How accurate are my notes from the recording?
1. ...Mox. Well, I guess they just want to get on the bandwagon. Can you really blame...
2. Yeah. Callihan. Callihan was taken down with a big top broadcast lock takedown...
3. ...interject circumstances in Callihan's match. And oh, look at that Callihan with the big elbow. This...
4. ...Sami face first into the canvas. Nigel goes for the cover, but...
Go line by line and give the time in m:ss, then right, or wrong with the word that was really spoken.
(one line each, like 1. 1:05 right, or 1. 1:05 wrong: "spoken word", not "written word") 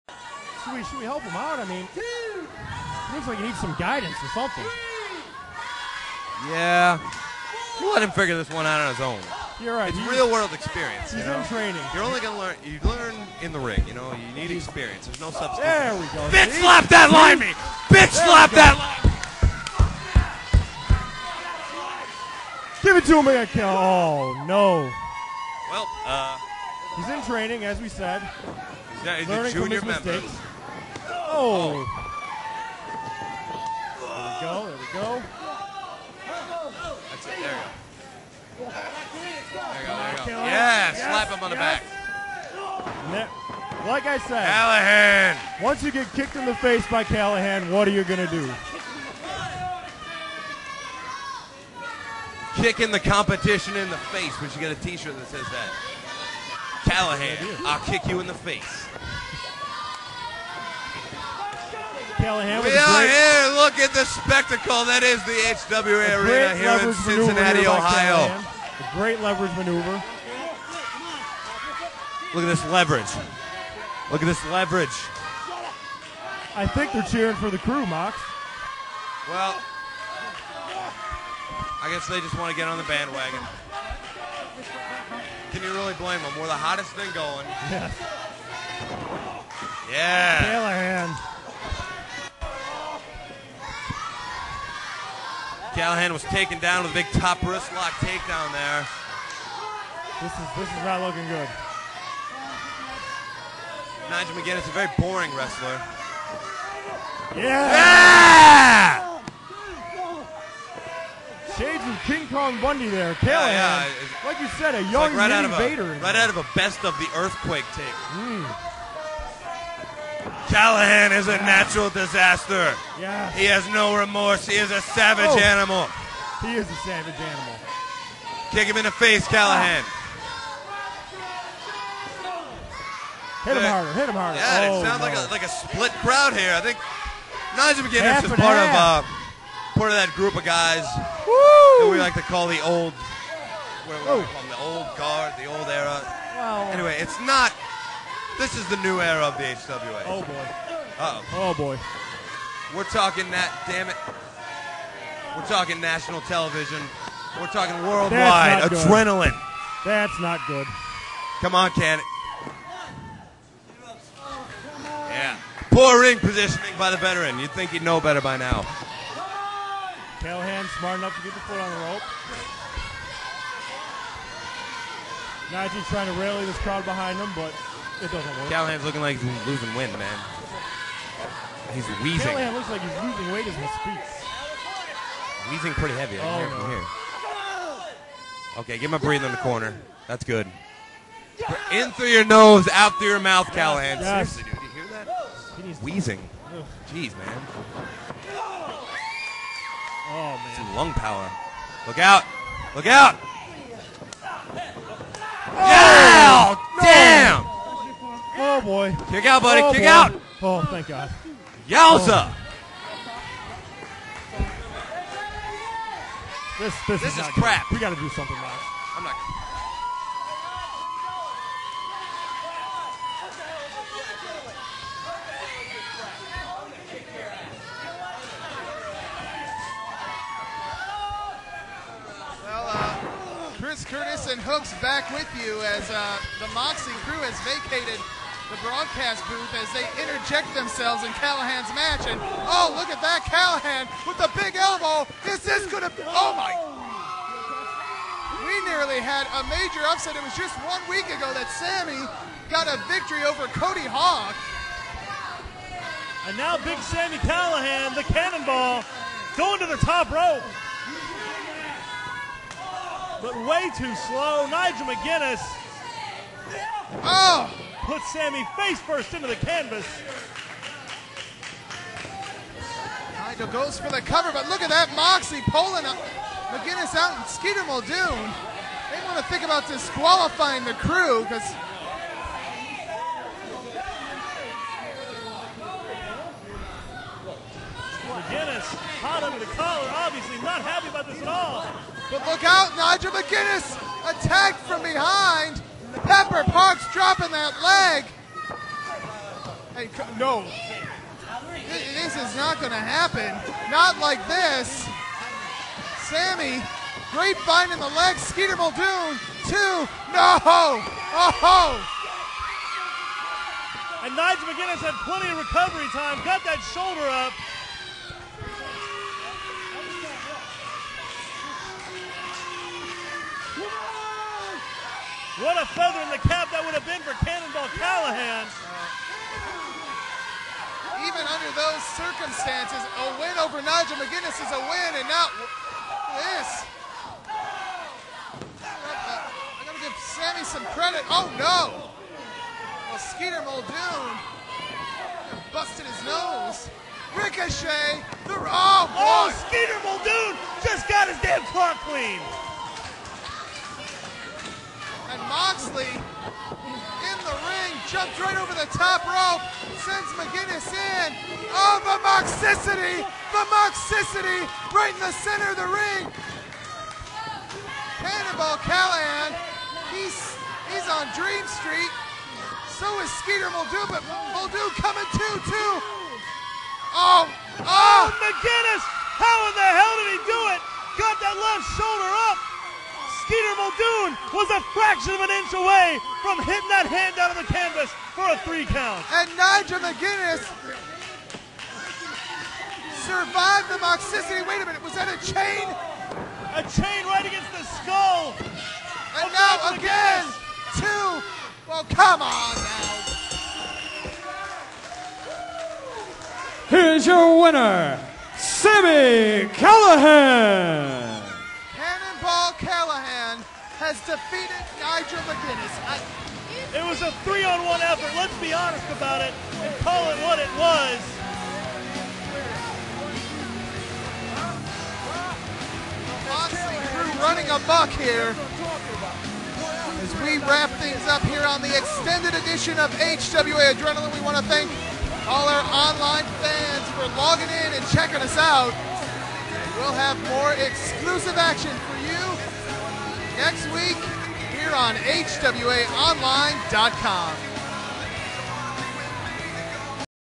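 1. 1:17 right
2. 1:29 wrong: "wrist", not "broadcast"
3. 4:00 wrong: "themselves", not "circumstances"
4. 4:28 right.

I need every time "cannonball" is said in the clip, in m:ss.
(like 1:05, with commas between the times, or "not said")
4:18, 5:27, 6:08, 6:51.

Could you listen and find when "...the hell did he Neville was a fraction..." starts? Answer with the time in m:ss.
6:19.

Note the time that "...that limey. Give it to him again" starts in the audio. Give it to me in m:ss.
0:18.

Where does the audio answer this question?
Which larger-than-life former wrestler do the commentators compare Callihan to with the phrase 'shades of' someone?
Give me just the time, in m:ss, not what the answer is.
1:52.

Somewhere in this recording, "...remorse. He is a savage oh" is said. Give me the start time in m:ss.
2:03.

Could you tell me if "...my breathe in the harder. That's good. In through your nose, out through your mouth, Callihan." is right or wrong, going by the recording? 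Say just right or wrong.
wrong.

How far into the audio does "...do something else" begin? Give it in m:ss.
3:38.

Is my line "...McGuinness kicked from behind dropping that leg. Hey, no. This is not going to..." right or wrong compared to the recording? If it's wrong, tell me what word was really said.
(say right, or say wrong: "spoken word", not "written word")
wrong: "attacked", not "kicked".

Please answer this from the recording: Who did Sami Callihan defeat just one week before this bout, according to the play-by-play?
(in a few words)
Cody Hawk.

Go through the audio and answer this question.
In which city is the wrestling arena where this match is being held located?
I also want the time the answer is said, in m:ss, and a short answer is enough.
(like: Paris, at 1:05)
Cincinnati, Ohio, at 1:06.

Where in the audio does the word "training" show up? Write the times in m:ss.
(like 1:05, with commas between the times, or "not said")
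0:11, 0:27.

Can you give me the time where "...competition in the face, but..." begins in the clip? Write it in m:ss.
0:52.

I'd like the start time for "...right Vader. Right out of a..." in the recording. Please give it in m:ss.
1:55.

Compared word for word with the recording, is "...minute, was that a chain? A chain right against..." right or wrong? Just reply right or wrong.
right.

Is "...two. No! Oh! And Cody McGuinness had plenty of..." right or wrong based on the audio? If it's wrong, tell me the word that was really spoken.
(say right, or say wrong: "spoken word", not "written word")
wrong: "Nigel", not "Cody".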